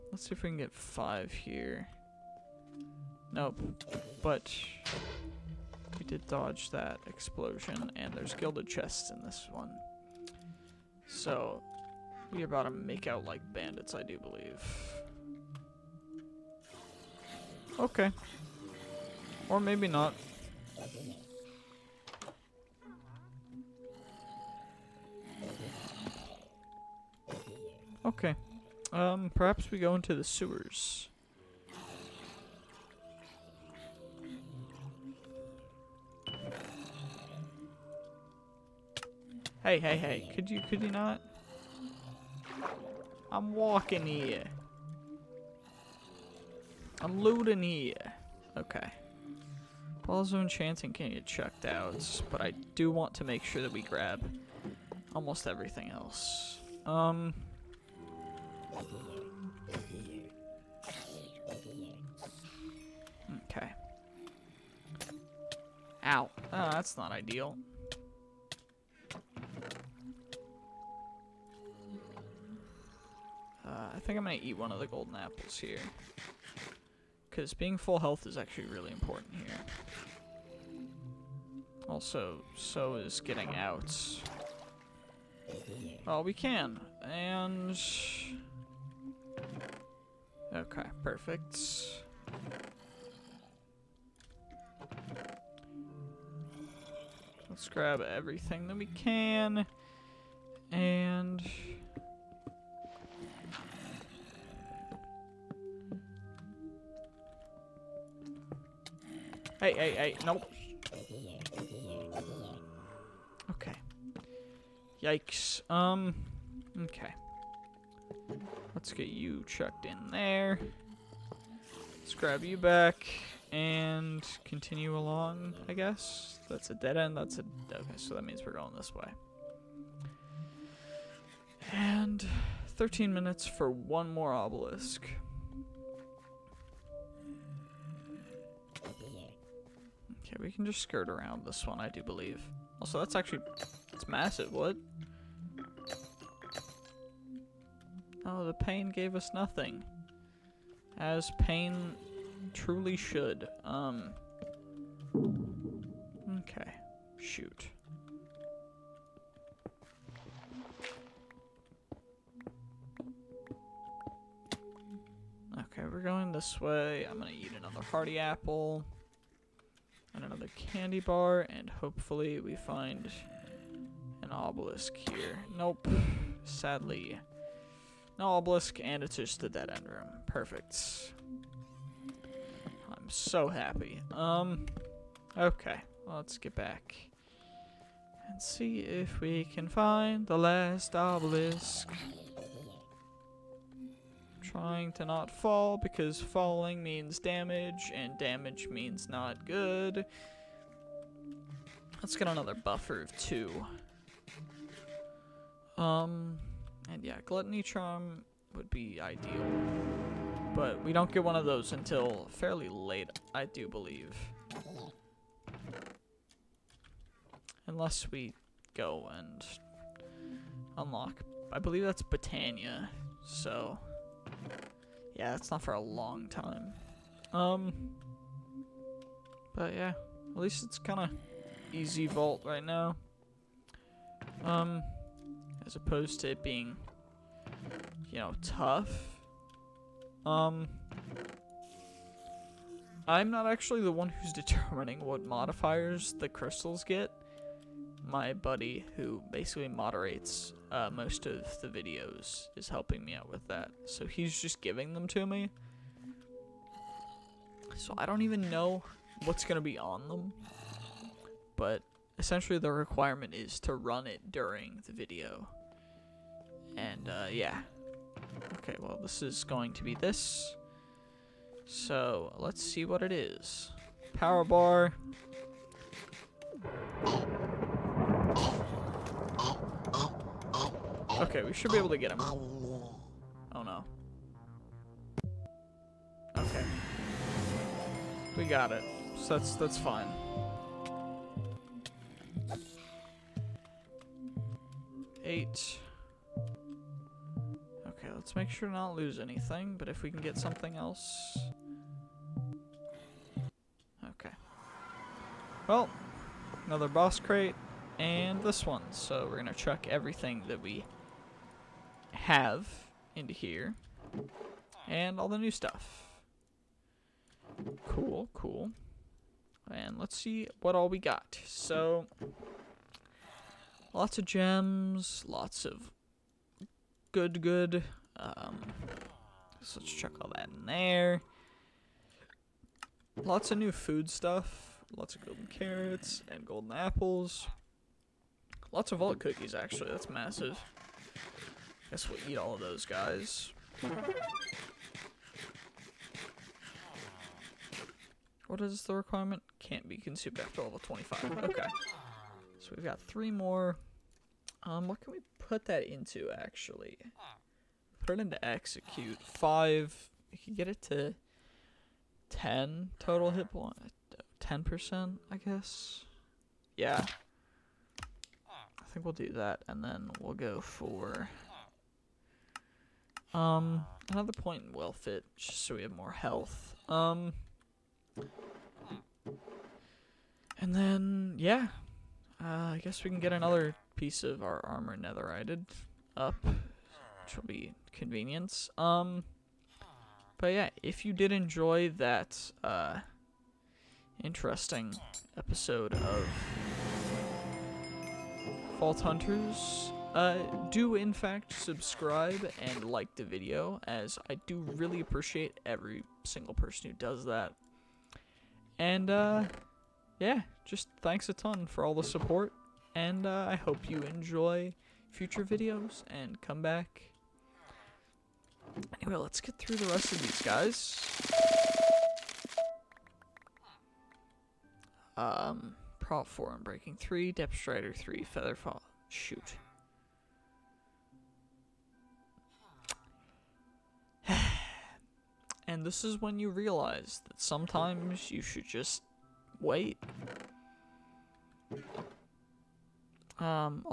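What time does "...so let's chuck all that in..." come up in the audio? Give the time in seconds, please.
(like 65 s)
329 s.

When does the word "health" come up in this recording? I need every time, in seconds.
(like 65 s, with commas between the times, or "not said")
77 s, 376 s.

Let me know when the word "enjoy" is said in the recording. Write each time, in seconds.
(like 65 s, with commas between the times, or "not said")
391 s, 414 s.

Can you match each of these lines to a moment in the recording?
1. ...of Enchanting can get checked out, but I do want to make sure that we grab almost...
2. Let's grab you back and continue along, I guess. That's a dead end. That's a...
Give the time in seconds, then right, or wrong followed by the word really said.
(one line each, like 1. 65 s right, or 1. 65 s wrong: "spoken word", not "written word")
1. 50 s right
2. 121 s right.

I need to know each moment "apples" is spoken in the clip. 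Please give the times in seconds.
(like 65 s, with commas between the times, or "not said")
75 s, 168 s, 336 s.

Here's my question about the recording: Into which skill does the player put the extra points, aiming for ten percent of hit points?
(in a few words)
execute.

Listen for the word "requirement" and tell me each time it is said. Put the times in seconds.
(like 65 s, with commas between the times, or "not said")
262 s, 348 s.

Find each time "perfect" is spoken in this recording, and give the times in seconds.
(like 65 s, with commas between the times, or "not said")
91 s, 180 s.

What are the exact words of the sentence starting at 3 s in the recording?
Nope, but we did dodge that explosion, and there's gilded chests in this one.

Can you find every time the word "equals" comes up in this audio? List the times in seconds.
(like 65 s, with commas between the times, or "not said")
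not said.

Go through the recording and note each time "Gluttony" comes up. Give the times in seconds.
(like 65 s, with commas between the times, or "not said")
207 s.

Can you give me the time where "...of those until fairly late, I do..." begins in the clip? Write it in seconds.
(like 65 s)
211 s.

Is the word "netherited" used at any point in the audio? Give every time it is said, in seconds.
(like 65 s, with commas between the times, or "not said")
384 s.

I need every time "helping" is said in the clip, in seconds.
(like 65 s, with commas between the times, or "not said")
252 s.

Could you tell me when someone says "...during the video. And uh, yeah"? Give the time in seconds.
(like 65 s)
264 s.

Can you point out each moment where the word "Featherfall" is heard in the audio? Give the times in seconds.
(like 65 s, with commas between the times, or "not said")
428 s.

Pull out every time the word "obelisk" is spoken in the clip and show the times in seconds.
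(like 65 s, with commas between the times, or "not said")
134 s, 174 s, 178 s, 190 s.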